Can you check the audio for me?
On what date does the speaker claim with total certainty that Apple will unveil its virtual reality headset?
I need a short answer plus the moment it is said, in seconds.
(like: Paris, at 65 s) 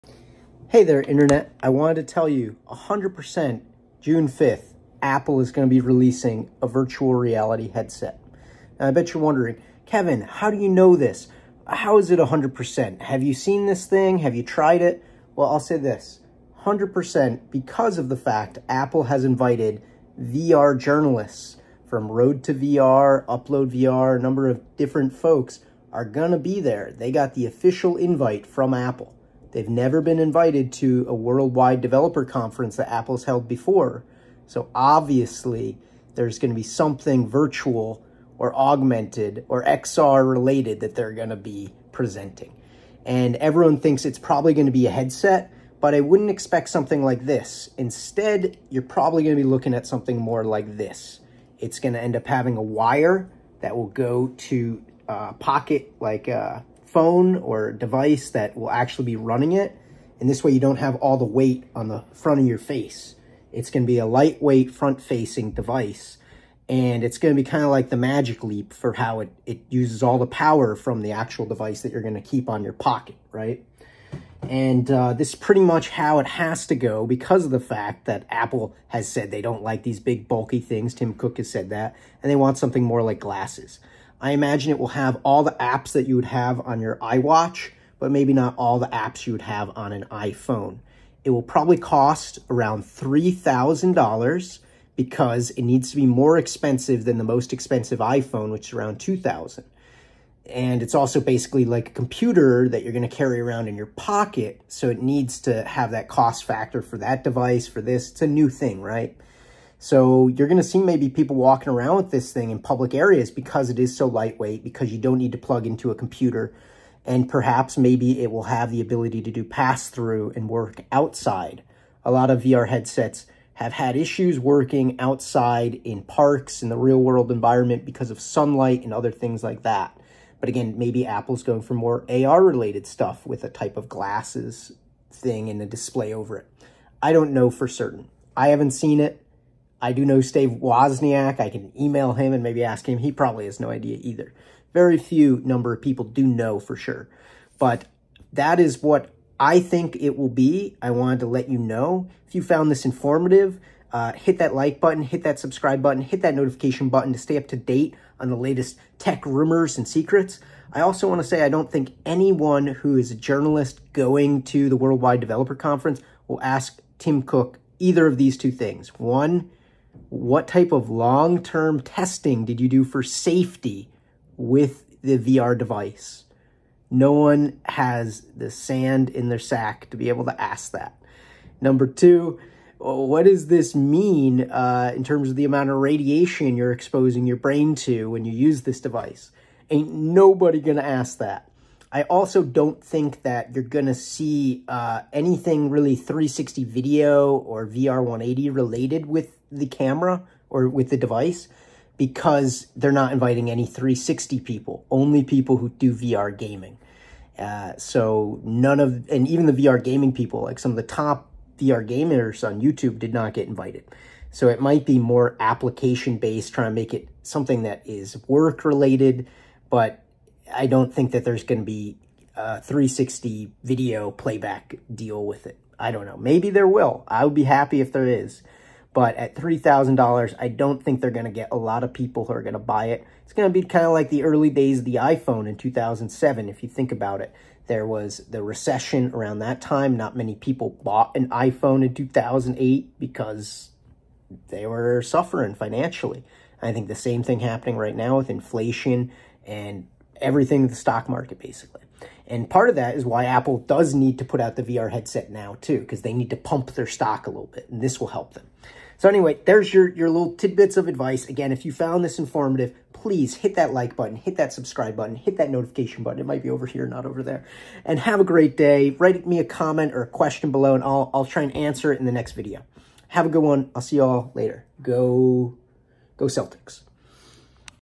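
June 5th, at 3 s.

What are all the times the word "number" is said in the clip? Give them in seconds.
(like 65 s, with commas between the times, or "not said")
24 s, 145 s, 181 s.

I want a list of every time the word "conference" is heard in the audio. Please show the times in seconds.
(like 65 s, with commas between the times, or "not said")
32 s, 165 s.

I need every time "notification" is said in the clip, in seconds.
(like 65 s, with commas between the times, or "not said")
156 s, 265 s.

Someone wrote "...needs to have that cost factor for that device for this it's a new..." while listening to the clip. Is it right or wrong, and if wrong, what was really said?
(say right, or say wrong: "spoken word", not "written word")
right.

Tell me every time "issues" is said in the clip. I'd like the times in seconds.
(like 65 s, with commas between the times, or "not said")
123 s.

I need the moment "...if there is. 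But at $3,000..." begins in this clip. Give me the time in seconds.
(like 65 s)
227 s.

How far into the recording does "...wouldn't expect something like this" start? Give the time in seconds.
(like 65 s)
46 s.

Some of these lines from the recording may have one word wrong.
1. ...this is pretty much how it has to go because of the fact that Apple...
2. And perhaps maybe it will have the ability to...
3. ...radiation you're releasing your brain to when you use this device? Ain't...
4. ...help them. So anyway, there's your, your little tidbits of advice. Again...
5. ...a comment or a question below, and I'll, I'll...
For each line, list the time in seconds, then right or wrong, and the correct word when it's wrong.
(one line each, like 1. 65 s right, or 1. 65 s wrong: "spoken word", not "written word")
1. 75 s right
2. 117 s right
3. 185 s wrong: "exposing", not "releasing"
4. 258 s right
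5. 269 s right.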